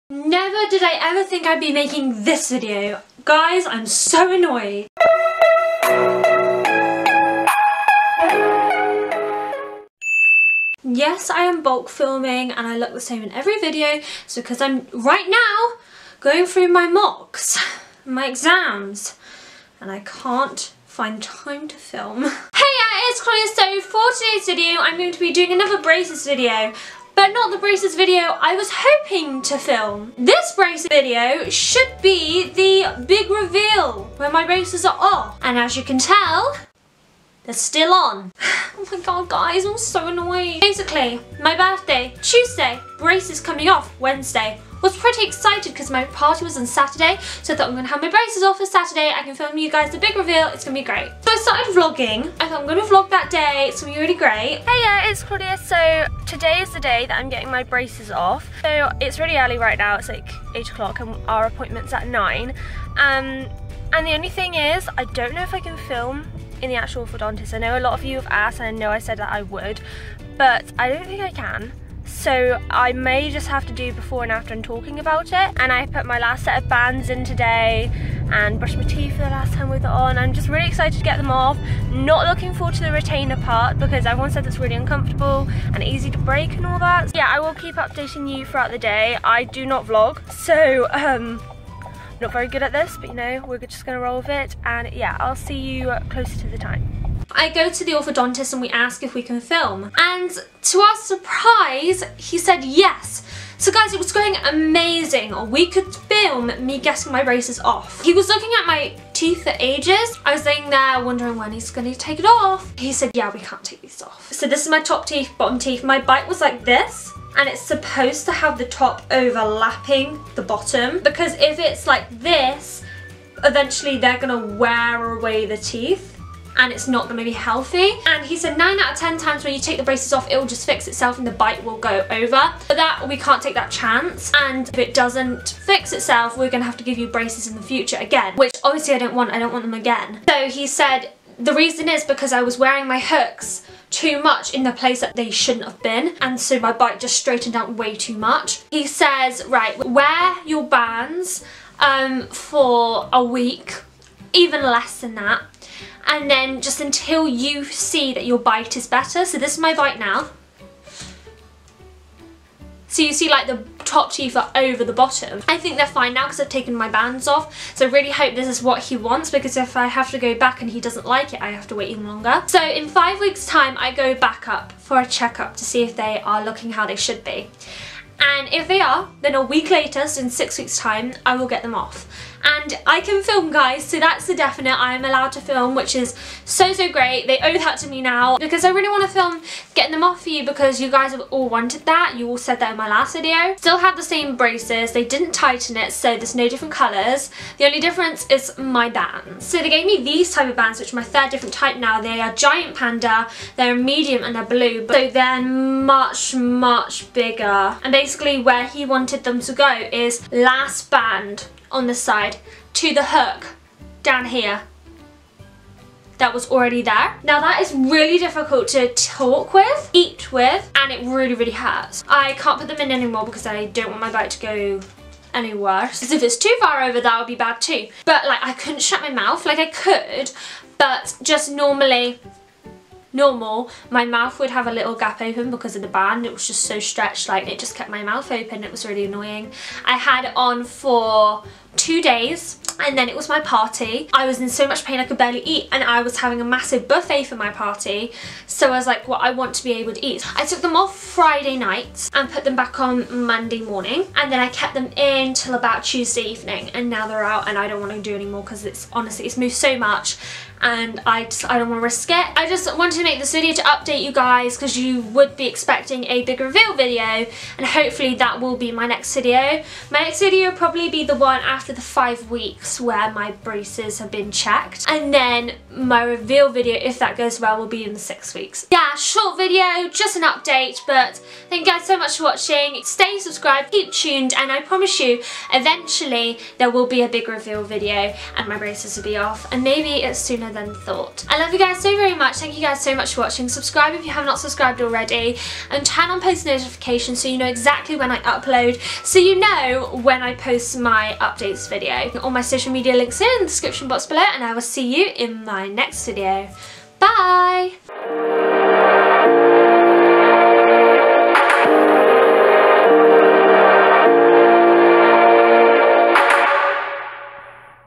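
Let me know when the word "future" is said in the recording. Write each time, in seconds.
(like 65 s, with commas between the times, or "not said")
137 s.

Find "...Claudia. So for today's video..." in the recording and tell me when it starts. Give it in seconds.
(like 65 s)
23 s.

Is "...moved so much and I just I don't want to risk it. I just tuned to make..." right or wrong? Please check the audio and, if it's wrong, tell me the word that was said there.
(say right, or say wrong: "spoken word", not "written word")
wrong: "wanted", not "tuned".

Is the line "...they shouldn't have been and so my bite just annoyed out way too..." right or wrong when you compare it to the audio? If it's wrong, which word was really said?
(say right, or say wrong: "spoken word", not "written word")
wrong: "straightened", not "annoyed".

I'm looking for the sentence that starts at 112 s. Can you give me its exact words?
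He said, yeah, we can't take these off.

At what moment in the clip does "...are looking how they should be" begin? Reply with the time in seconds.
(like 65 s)
176 s.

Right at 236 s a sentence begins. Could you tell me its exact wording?
It was just so stretched, like it just kept my mouth open.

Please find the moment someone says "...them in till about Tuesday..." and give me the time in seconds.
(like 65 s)
254 s.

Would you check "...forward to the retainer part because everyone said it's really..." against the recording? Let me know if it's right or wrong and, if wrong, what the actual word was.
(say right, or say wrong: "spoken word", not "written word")
right.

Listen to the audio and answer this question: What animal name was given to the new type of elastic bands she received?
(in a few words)
Giant panda.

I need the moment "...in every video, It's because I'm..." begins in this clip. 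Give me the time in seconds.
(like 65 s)
13 s.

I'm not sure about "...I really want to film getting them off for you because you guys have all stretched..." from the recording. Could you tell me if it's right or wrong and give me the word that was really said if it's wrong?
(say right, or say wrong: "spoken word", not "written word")
wrong: "wanted", not "stretched".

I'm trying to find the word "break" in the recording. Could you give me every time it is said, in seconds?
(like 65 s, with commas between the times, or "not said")
86 s.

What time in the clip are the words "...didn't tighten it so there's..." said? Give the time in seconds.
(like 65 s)
195 s.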